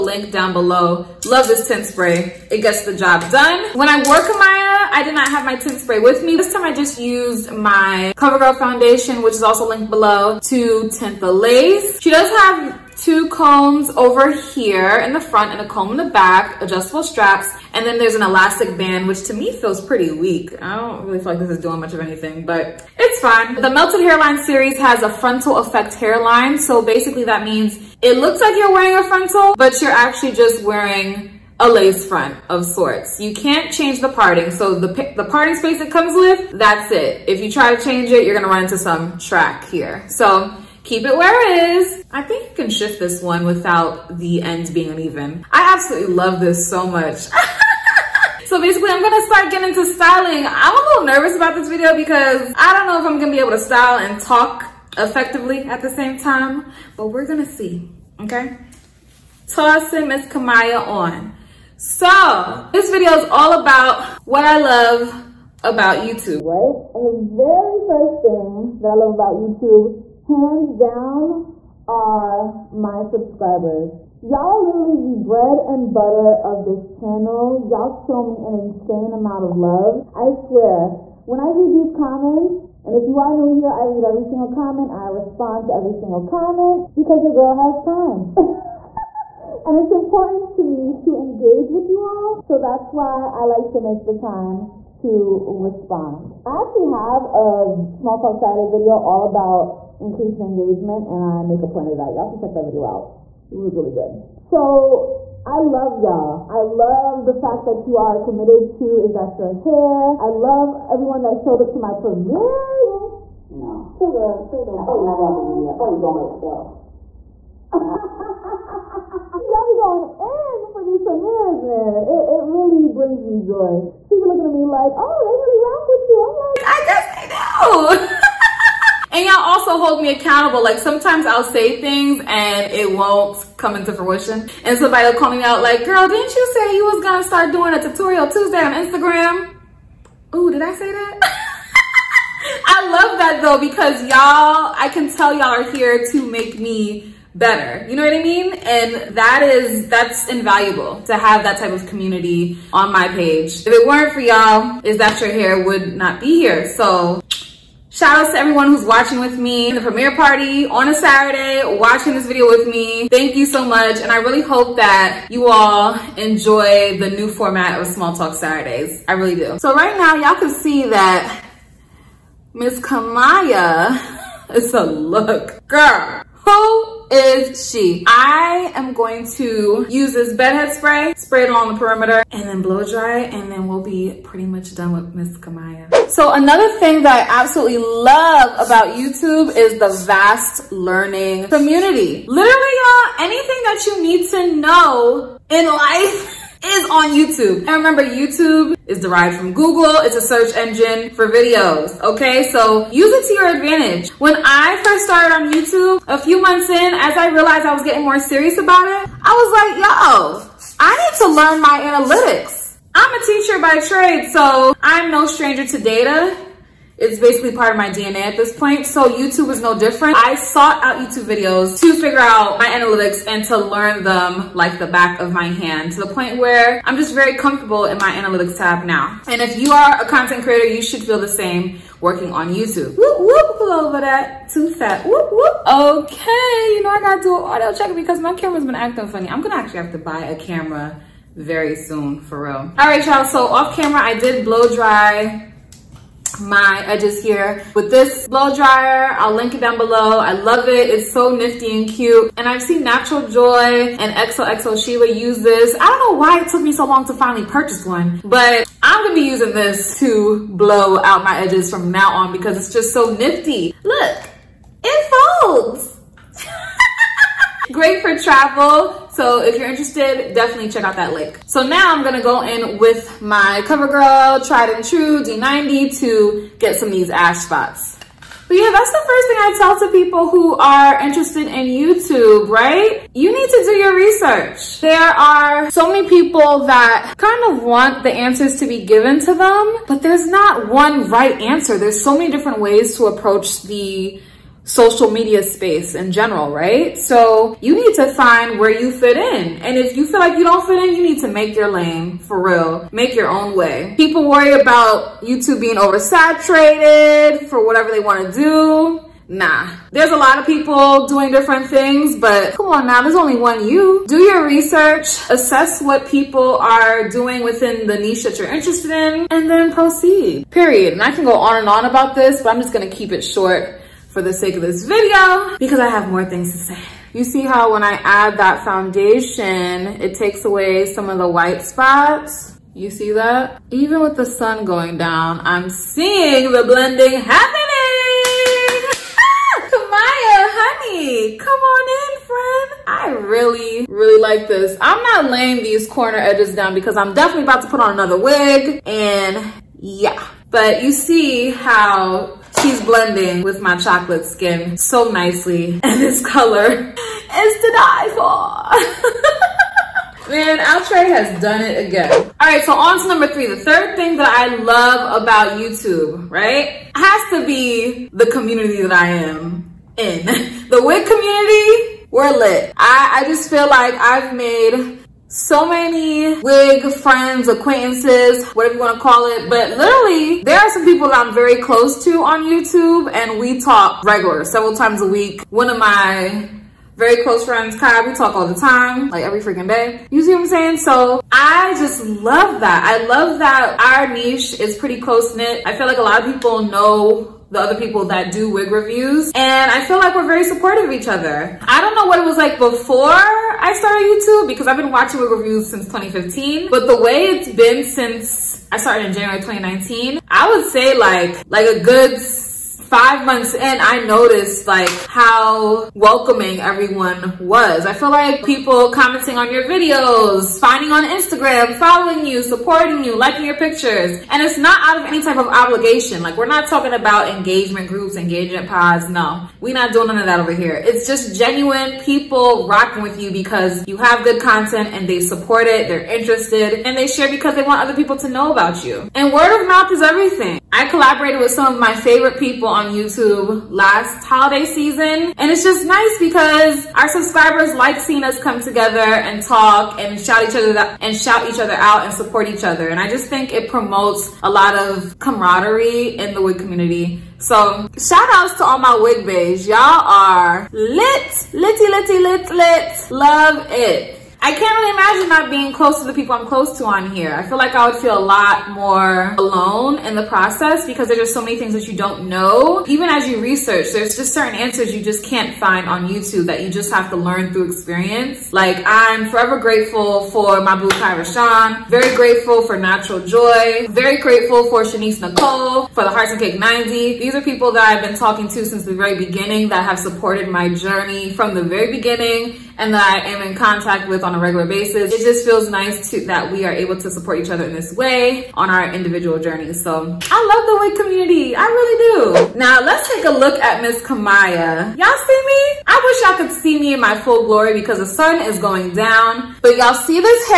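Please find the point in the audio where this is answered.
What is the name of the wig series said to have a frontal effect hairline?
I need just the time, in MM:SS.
00:23.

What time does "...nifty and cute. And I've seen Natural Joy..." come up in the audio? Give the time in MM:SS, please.
04:11.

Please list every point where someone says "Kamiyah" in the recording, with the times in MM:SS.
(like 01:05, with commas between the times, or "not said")
00:04, 01:00, 02:52, 03:05, 05:39, 08:24.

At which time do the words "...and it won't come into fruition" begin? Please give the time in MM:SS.
02:12.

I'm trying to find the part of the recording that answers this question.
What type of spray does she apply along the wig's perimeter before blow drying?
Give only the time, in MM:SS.
03:00.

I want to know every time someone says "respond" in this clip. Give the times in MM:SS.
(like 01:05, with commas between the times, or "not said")
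01:25, 01:35.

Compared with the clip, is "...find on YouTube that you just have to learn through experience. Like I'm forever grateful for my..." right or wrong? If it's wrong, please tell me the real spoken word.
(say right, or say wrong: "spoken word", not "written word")
right.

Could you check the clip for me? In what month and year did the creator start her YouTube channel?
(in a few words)
January 2019.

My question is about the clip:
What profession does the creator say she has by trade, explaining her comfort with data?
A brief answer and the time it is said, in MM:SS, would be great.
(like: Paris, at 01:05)
teacher, at 03:33.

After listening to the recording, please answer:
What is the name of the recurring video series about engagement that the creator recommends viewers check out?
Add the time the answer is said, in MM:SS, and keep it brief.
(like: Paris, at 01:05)
Small Talk Saturday, at 01:37.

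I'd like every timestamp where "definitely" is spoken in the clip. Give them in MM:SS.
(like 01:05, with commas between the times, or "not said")
04:30, 05:47.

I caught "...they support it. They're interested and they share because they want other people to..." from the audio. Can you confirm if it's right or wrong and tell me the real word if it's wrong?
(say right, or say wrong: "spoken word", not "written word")
right.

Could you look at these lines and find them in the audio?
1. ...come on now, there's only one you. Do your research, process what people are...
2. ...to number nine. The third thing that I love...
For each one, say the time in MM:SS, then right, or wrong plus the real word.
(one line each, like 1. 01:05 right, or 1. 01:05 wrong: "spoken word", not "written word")
1. 05:12 wrong: "assess", not "process"
2. 06:03 wrong: "three", not "nine".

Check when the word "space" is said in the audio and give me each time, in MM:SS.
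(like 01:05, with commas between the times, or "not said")
00:35, 04:55.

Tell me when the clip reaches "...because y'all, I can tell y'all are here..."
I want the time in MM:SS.
02:23.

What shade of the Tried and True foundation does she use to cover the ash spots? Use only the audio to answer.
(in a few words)
D90.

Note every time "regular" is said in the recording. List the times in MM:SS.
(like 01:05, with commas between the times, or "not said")
06:24, 08:14.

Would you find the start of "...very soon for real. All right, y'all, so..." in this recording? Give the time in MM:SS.
04:01.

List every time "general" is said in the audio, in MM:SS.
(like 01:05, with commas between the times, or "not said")
04:56.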